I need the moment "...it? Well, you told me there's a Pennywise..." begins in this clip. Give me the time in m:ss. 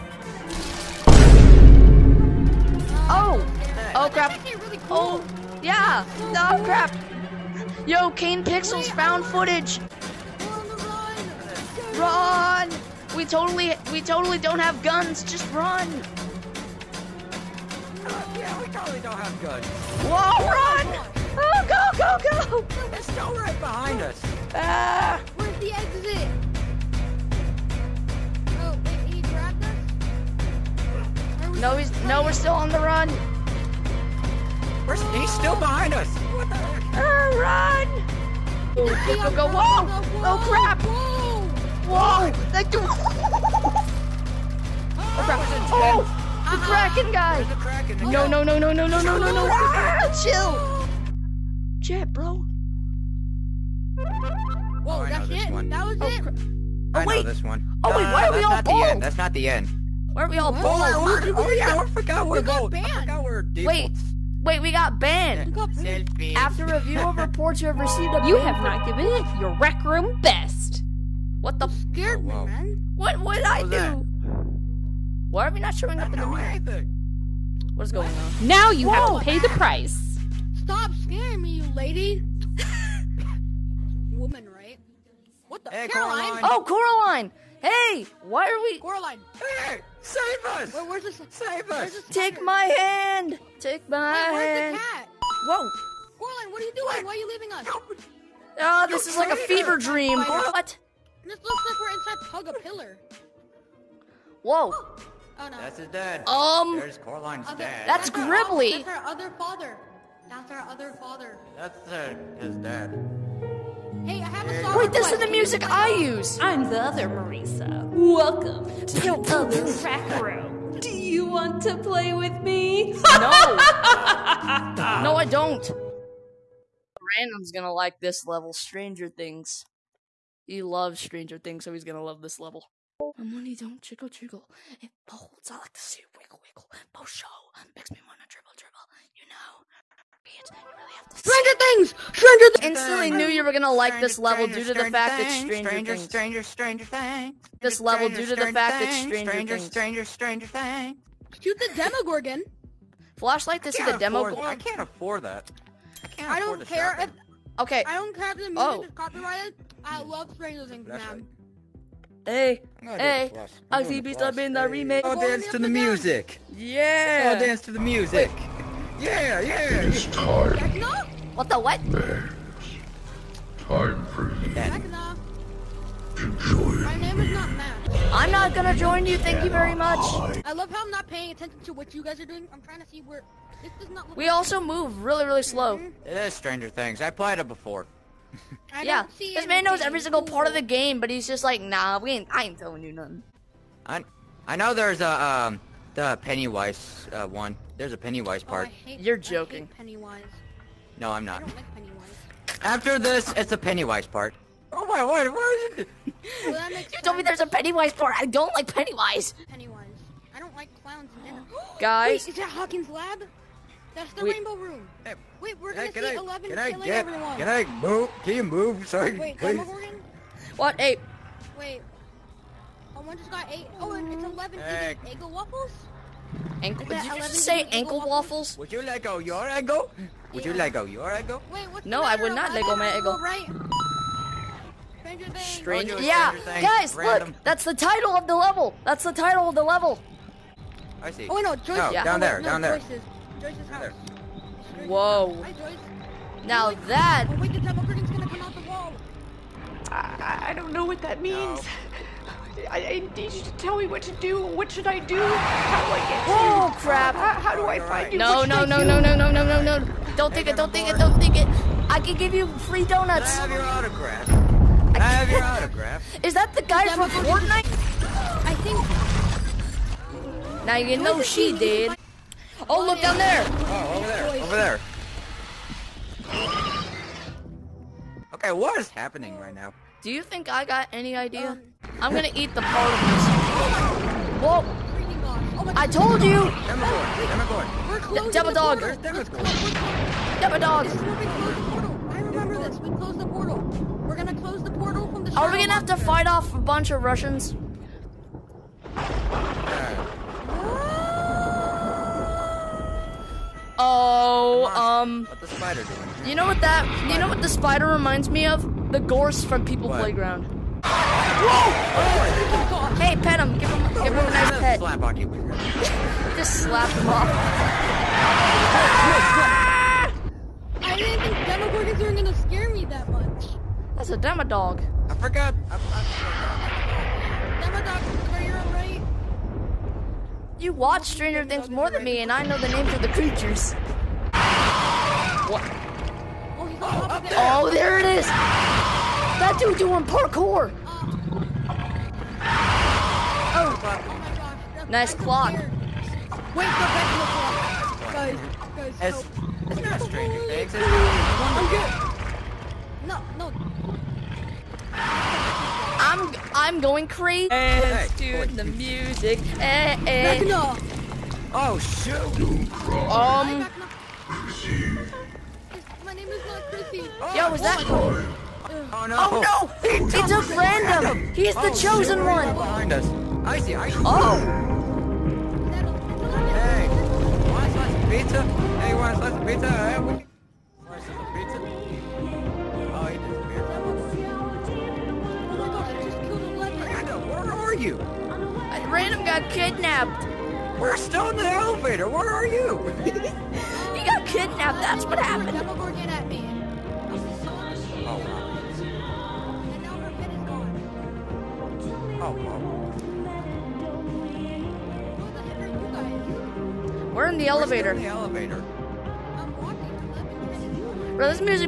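3:25.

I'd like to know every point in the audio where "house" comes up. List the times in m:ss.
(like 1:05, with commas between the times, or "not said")
4:03.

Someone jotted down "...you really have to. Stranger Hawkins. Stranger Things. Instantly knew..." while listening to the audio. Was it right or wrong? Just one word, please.
wrong.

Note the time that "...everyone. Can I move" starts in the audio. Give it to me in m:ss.
3:37.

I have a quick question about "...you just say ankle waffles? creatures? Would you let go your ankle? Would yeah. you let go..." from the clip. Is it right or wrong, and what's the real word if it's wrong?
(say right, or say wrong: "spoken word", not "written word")
wrong: "waffles", not "creatures".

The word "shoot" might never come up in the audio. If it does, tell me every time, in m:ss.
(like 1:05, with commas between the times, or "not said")
2:31, 6:01.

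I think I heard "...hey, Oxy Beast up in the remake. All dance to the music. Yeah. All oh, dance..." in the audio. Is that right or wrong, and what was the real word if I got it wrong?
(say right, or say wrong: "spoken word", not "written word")
right.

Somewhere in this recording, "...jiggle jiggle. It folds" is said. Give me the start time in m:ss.
2:13.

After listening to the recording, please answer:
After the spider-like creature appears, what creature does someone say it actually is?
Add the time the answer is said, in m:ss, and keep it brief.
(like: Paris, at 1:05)
Demodog, at 5:24.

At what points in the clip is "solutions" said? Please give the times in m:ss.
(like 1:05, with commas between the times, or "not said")
not said.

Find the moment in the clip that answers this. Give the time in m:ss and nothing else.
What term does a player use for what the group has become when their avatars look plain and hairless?
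1:03.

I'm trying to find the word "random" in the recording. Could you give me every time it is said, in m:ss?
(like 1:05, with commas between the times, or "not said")
2:07, 3:56, 6:10.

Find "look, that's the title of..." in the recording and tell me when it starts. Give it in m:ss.
3:57.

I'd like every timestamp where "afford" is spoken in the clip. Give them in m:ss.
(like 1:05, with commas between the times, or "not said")
2:34.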